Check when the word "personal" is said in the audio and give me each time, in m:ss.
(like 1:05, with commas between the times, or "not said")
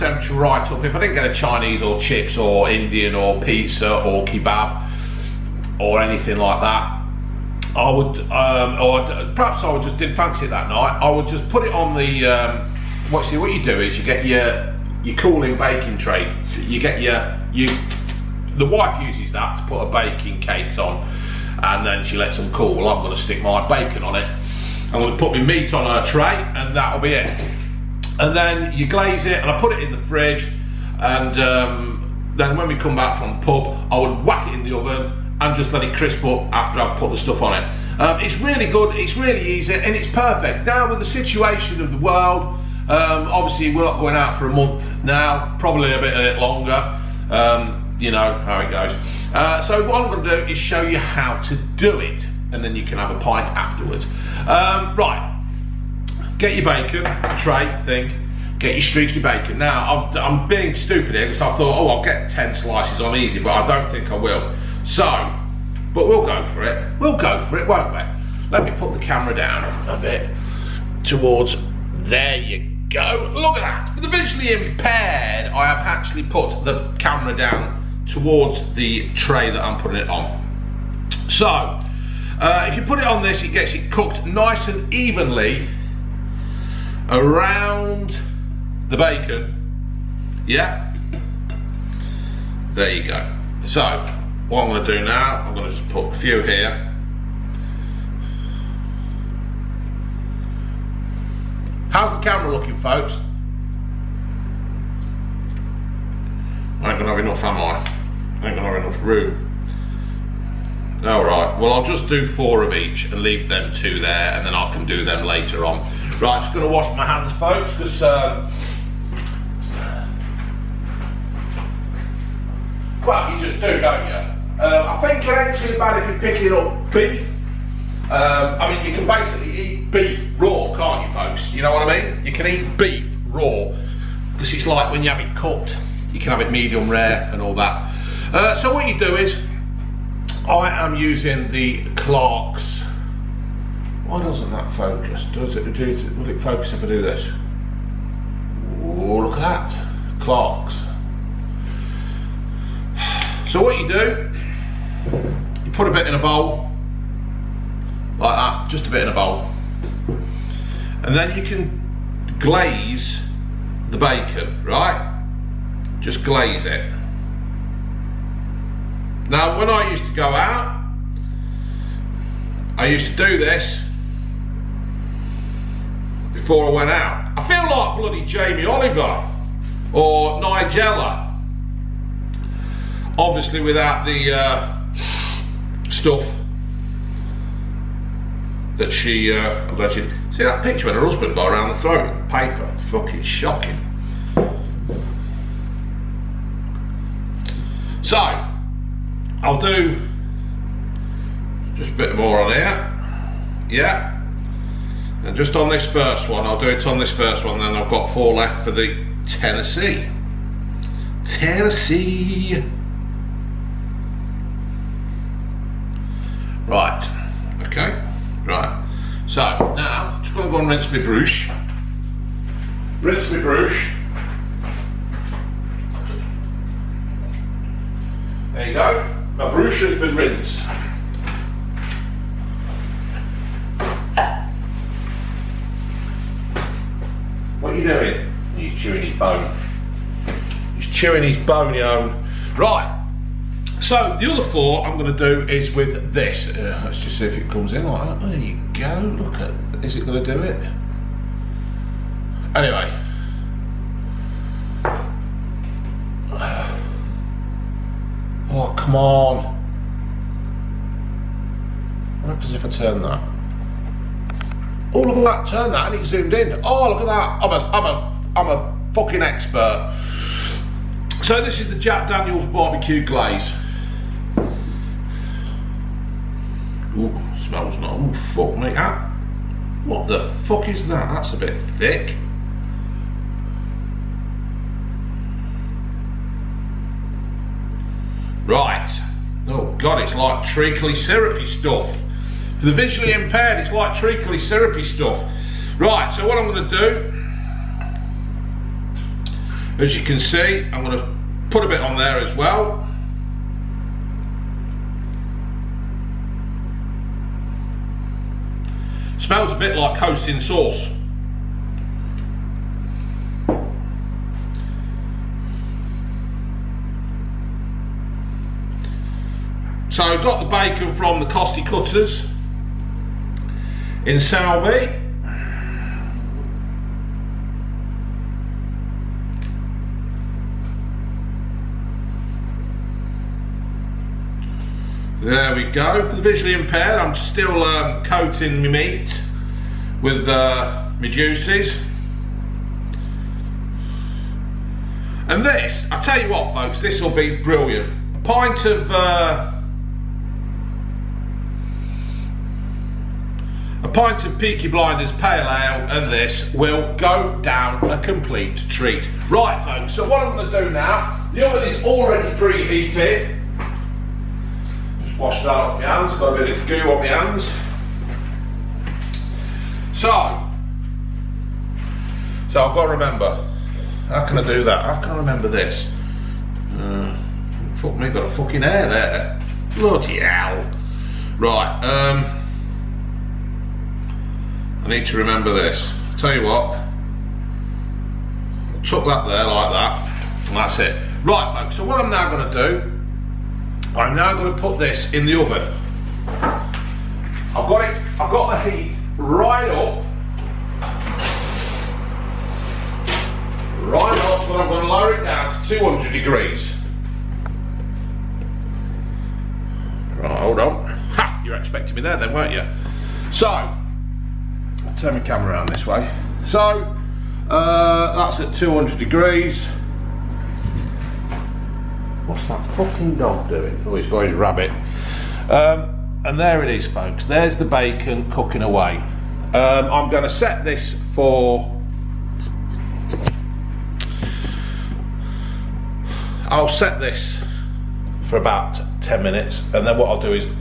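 not said.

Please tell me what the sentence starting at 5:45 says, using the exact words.
And this, I tell you what folks, this will be brilliant.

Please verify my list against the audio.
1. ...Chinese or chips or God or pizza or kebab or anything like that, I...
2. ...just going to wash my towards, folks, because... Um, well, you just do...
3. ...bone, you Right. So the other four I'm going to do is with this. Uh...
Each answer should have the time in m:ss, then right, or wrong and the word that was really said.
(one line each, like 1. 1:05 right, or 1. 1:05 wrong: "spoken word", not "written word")
1. 0:01 wrong: "Indian", not "God"
2. 1:56 wrong: "hands", not "towards"
3. 4:01 right.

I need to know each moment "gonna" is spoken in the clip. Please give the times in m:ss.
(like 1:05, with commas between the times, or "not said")
3:40, 4:56, 5:00.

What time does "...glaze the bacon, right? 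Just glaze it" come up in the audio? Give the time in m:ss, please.
2:42.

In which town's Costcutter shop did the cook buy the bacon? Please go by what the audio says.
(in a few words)
Salby.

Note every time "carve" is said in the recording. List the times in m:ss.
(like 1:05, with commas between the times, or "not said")
not said.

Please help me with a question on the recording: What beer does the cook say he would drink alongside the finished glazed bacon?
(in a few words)
Peaky Blinders Pale Ale.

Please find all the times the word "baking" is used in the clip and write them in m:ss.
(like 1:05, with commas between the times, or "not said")
0:15, 0:19.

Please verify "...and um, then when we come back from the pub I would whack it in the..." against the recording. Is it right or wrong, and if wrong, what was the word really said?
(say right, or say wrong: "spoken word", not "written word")
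right.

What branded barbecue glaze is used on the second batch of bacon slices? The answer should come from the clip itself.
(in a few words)
Jack Daniels.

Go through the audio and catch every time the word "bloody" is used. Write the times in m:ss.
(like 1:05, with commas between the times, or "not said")
2:57, 6:19.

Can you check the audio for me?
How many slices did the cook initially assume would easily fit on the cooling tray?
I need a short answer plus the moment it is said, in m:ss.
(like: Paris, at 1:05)
10, at 1:02.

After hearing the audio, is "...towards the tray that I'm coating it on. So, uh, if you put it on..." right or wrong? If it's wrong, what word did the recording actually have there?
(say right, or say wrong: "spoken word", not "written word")
wrong: "putting", not "coating".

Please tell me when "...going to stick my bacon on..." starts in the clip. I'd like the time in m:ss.
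0:23.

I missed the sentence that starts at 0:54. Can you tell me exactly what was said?
Um, right, get your bacon, tray thing, get your streaky bacon.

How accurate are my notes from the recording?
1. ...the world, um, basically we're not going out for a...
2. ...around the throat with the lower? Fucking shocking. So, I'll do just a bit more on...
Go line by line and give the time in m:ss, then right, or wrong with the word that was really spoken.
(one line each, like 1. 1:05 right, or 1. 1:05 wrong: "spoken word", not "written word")
1. 0:41 wrong: "obviously", not "basically"
2. 3:11 wrong: "paper", not "lower".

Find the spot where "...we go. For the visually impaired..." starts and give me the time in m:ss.
5:35.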